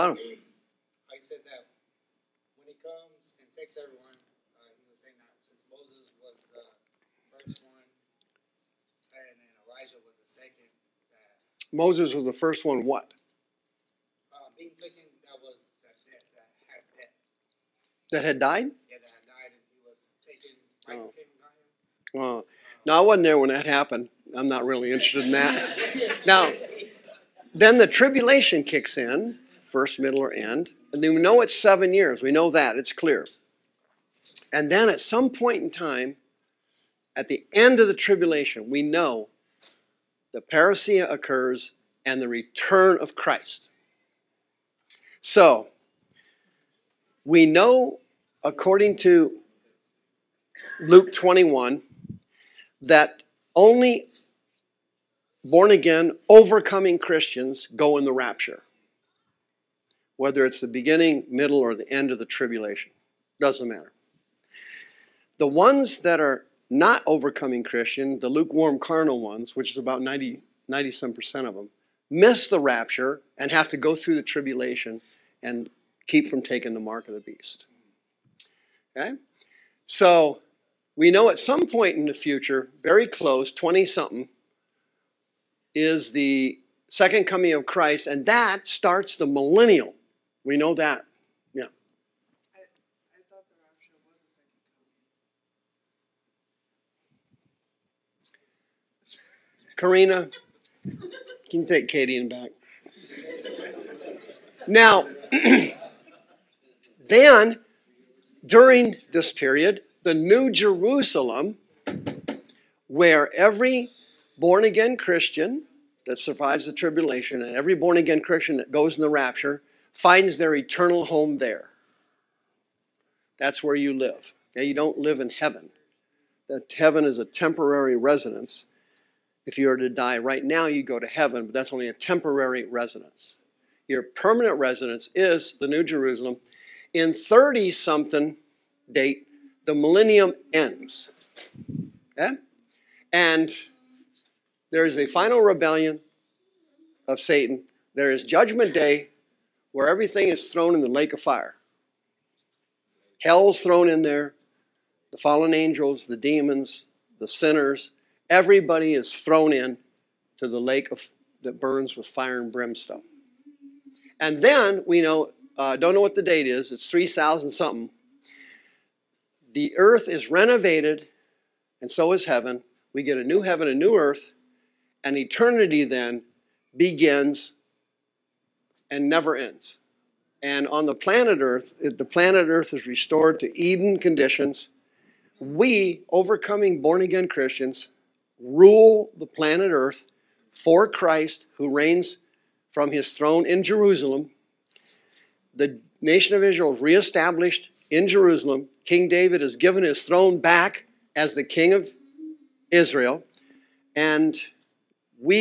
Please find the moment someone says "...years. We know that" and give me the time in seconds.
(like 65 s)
31 s.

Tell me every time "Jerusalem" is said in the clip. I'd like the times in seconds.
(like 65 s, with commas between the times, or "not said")
110 s, 135 s, 193 s, 198 s.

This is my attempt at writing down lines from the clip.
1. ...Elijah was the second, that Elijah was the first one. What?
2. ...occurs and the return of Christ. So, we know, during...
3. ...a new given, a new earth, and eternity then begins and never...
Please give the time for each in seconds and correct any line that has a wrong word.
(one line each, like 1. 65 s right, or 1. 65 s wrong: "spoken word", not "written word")
1. 9 s wrong: "Moses", not "Elijah"
2. 41 s wrong: "according", not "during"
3. 173 s wrong: "heaven", not "given".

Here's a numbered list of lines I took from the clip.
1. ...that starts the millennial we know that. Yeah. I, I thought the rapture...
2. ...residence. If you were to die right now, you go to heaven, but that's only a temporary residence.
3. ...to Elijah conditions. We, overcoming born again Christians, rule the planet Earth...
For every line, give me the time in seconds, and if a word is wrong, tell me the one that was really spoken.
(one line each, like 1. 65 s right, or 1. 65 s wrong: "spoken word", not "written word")
1. 88 s right
2. 127 s right
3. 183 s wrong: "Eden", not "Elijah".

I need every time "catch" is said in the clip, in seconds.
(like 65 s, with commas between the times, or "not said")
not said.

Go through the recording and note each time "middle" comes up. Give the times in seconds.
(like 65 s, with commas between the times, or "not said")
29 s, 61 s.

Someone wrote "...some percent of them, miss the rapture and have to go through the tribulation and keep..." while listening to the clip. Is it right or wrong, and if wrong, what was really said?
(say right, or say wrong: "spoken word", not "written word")
right.